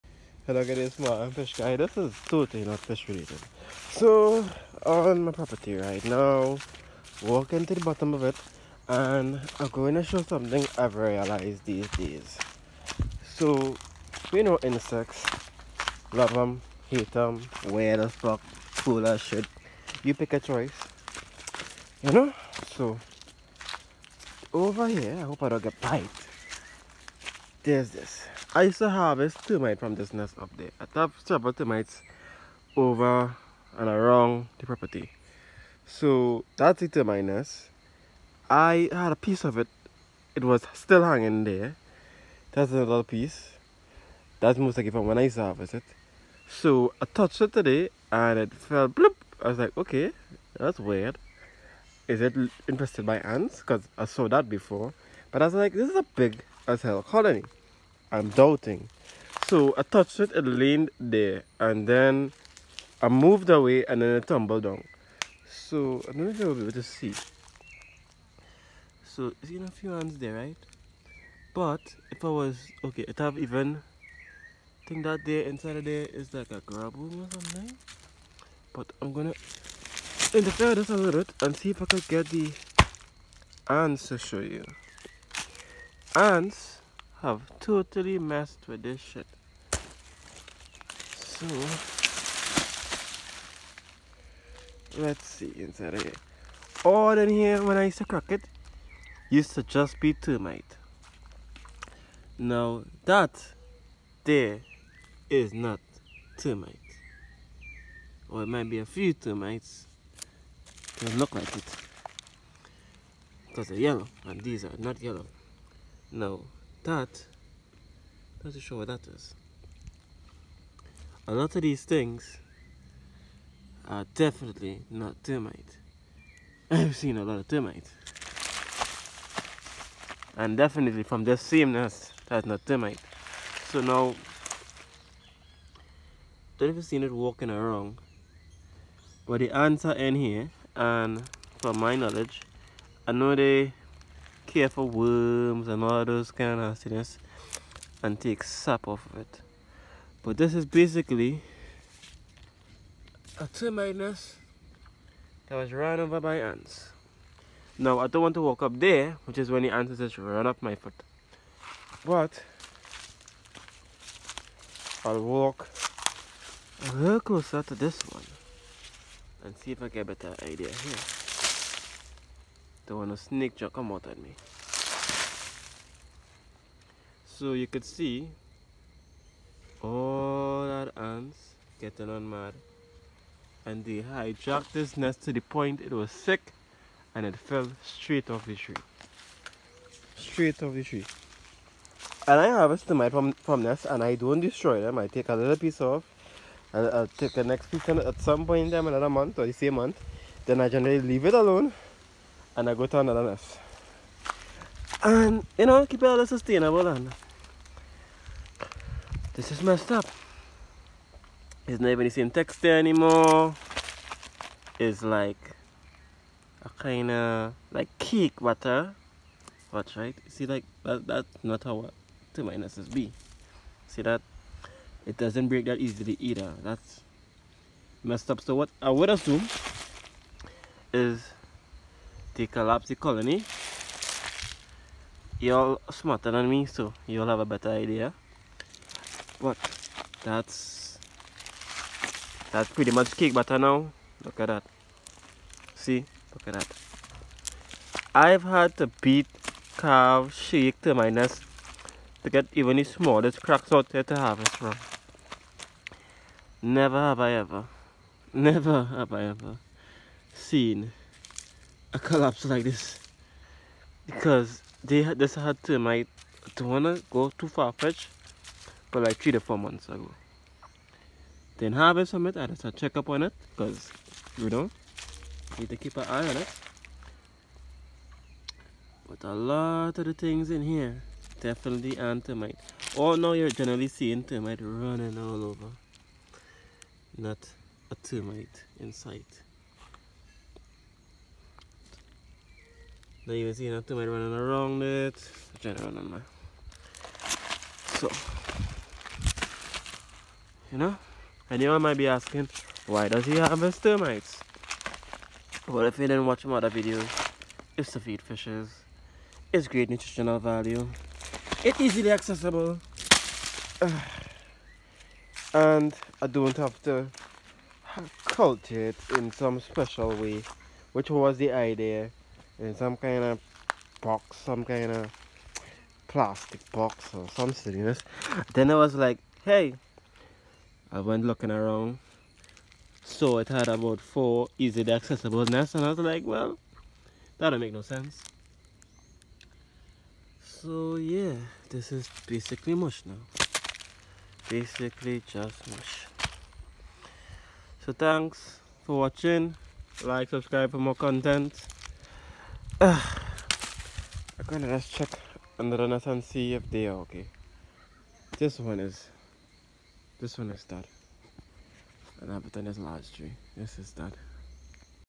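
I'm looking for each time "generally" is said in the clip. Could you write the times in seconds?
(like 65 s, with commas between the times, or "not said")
200 s, 283 s.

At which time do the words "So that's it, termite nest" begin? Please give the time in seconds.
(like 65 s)
35 s.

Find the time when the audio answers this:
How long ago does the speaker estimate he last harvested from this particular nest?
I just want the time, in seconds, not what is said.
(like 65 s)
269 s.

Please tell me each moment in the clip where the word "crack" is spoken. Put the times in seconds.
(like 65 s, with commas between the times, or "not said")
98 s, 253 s.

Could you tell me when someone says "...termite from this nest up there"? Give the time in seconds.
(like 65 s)
29 s.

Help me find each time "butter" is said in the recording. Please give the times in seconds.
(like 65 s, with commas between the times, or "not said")
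218 s, 243 s.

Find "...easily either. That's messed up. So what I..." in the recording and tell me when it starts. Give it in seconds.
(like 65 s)
225 s.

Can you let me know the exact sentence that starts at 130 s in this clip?
And definitely from the same nest, that's not termite.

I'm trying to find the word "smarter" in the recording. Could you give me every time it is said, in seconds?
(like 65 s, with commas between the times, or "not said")
235 s.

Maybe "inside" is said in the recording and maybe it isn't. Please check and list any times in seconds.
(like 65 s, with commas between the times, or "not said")
75 s, 95 s.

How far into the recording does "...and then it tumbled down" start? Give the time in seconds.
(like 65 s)
63 s.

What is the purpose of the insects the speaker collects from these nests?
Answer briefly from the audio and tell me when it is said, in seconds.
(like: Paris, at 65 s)
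To feed fishes, at 307 s.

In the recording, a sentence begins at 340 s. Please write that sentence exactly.
So yeah, this is basically mush now.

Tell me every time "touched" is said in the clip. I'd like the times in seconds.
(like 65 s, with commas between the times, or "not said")
47 s, 59 s.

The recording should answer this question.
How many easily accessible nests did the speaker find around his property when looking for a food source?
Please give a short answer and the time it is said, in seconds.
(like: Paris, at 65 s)
4, at 333 s.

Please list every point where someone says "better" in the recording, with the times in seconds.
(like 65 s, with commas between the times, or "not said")
170 s, 237 s.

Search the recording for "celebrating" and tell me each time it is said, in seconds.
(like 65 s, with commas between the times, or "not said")
not said.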